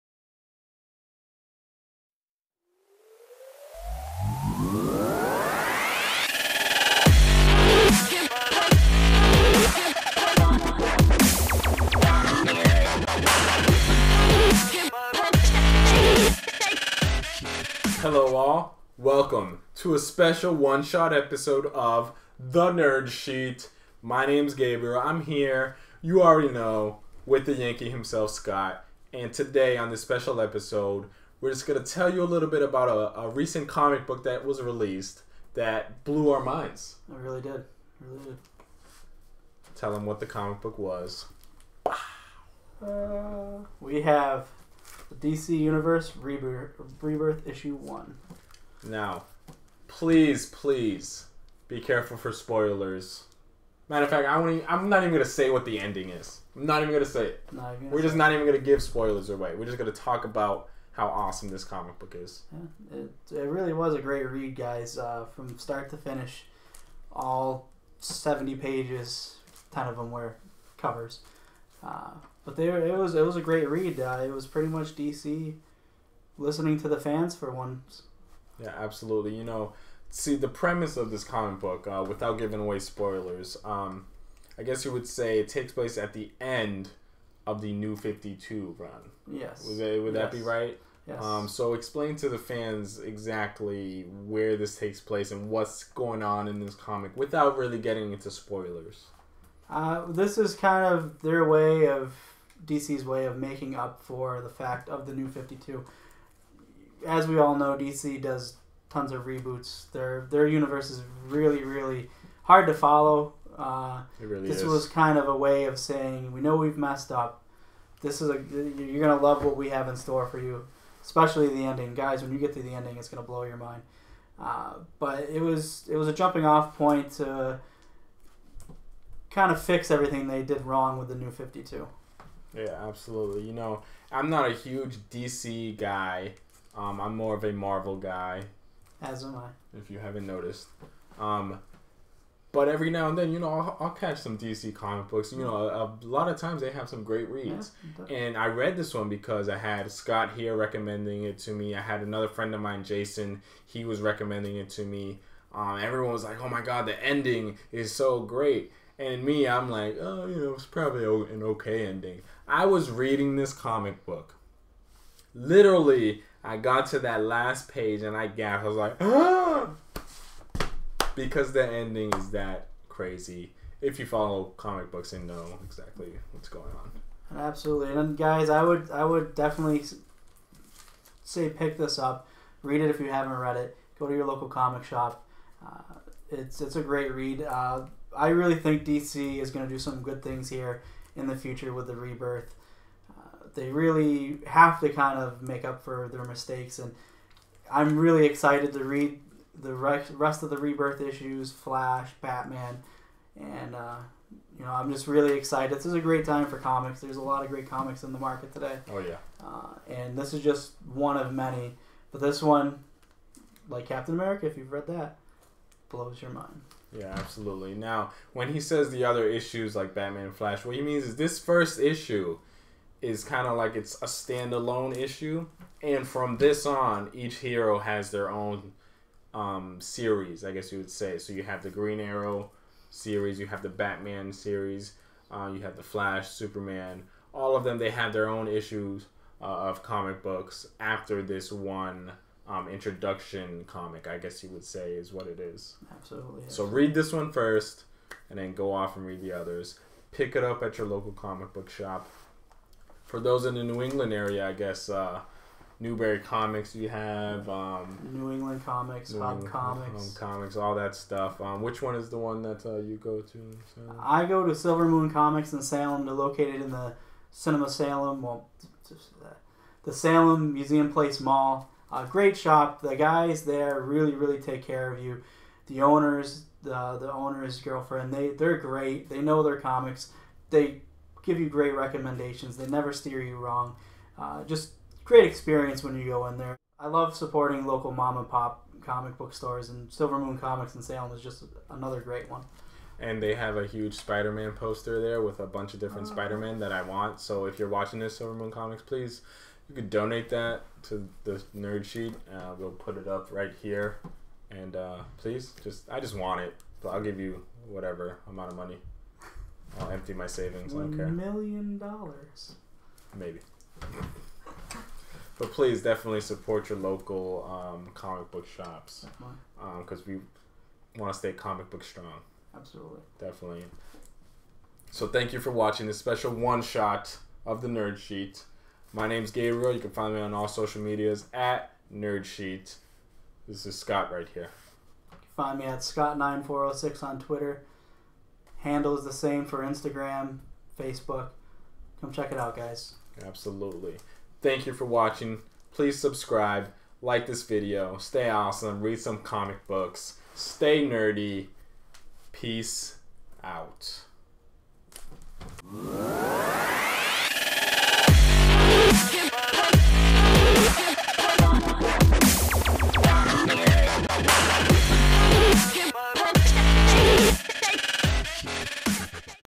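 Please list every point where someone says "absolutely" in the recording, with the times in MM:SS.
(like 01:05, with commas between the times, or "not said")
01:18, 02:12, 02:57, 03:37, 04:05, 05:22, 05:43.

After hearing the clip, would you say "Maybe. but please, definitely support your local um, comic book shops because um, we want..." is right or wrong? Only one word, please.
right.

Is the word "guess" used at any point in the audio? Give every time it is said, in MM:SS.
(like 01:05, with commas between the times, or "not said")
01:24, 03:50, 04:04, 04:14.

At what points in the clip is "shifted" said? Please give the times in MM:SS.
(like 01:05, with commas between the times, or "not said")
not said.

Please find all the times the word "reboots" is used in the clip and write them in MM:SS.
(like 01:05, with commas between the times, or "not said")
01:49.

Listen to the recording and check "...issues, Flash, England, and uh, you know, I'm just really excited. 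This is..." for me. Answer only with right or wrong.
wrong.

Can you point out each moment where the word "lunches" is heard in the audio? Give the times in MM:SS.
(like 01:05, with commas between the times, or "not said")
not said.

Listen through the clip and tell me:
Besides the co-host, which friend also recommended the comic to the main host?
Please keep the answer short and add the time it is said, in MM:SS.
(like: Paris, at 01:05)
Jason, at 02:32.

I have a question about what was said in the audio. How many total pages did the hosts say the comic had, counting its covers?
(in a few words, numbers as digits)
70.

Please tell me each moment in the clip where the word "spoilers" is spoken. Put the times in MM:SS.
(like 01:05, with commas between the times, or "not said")
00:52, 00:58, 01:22, 01:38.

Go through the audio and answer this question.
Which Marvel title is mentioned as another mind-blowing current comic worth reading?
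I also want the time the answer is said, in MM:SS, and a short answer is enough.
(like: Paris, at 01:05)
Captain America, at 03:33.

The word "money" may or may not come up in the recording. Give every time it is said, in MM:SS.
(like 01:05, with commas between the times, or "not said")
05:08.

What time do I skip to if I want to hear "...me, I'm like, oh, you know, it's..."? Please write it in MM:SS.
02:39.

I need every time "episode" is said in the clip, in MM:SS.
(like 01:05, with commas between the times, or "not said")
00:21, 00:30.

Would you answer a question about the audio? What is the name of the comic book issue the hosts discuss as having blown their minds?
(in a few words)
DC Universe Rebirth.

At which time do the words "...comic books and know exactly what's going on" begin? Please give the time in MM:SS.
02:54.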